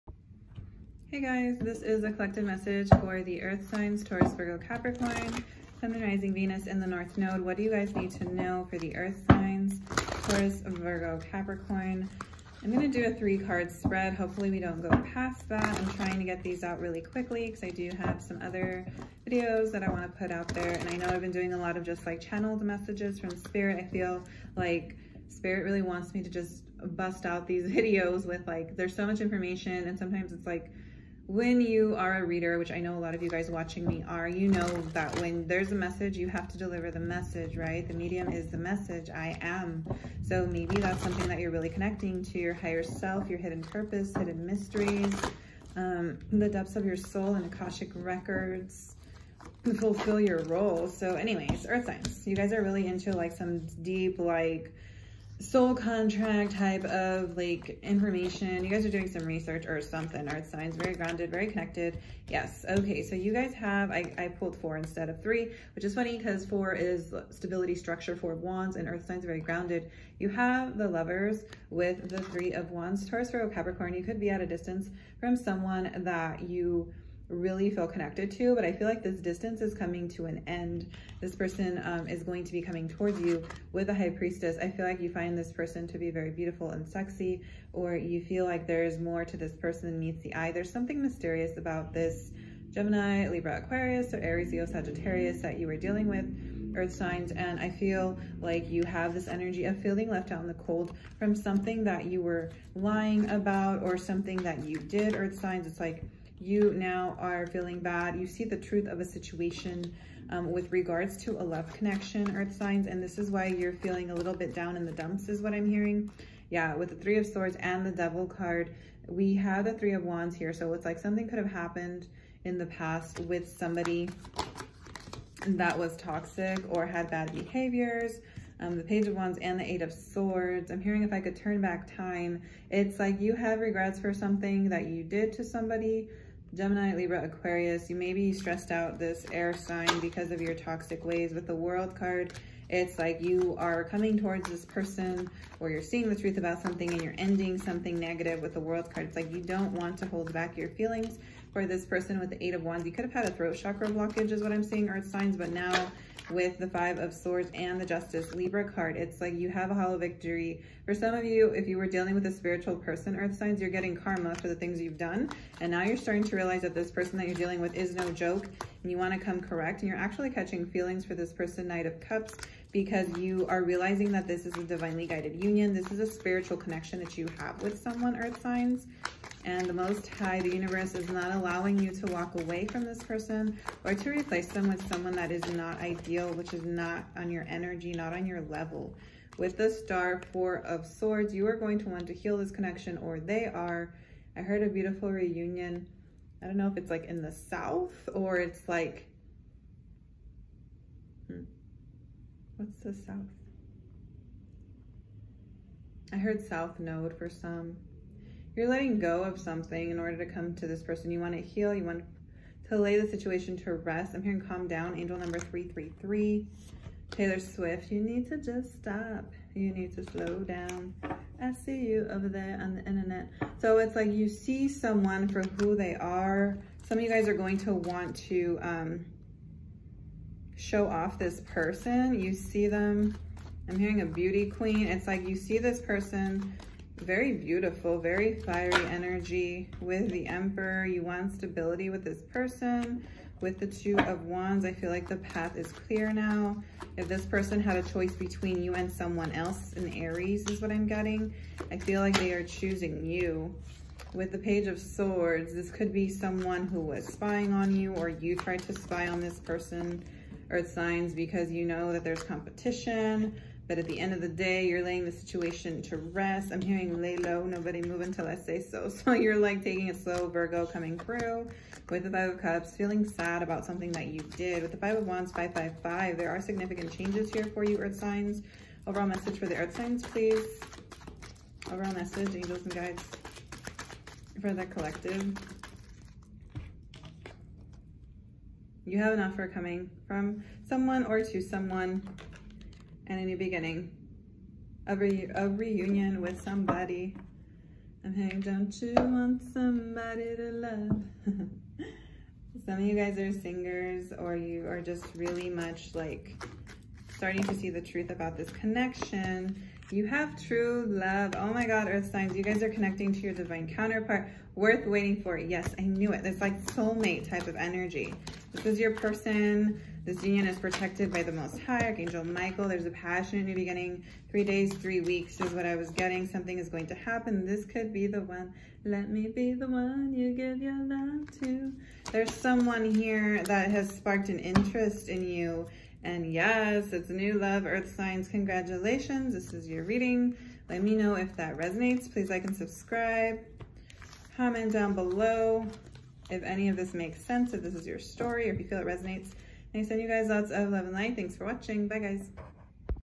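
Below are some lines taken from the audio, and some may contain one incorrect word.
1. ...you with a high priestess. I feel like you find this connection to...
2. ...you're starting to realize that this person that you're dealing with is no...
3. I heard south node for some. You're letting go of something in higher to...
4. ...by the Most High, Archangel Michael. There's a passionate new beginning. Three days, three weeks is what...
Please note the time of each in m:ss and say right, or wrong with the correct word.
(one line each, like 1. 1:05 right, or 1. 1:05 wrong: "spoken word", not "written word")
1. 1:23 wrong: "person", not "connection"
2. 2:45 right
3. 3:26 wrong: "order", not "higher"
4. 5:21 right.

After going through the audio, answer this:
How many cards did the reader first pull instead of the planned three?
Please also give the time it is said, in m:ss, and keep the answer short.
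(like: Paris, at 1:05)
4, at 1:04.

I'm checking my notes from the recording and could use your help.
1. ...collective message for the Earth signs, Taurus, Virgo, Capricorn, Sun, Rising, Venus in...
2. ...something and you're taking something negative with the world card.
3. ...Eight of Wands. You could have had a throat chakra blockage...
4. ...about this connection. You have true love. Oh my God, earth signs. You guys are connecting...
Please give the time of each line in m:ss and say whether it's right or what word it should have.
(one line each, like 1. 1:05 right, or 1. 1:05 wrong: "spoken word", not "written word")
1. 0:02 right
2. 2:26 wrong: "ending", not "taking"
3. 2:32 right
4. 5:08 right.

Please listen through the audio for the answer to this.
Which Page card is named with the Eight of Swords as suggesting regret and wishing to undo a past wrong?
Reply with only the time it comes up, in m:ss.
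2:08.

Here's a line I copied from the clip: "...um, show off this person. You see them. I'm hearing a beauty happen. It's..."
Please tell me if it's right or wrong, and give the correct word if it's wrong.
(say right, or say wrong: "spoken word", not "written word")
wrong: "queen", not "happen".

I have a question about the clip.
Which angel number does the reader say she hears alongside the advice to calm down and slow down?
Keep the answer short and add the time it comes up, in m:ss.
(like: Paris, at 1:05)
333, at 3:34.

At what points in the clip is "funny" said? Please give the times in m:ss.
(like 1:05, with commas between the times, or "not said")
1:05.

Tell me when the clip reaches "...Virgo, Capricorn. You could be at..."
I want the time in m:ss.
1:13.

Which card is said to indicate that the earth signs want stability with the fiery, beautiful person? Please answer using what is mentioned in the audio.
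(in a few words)
The Emperor.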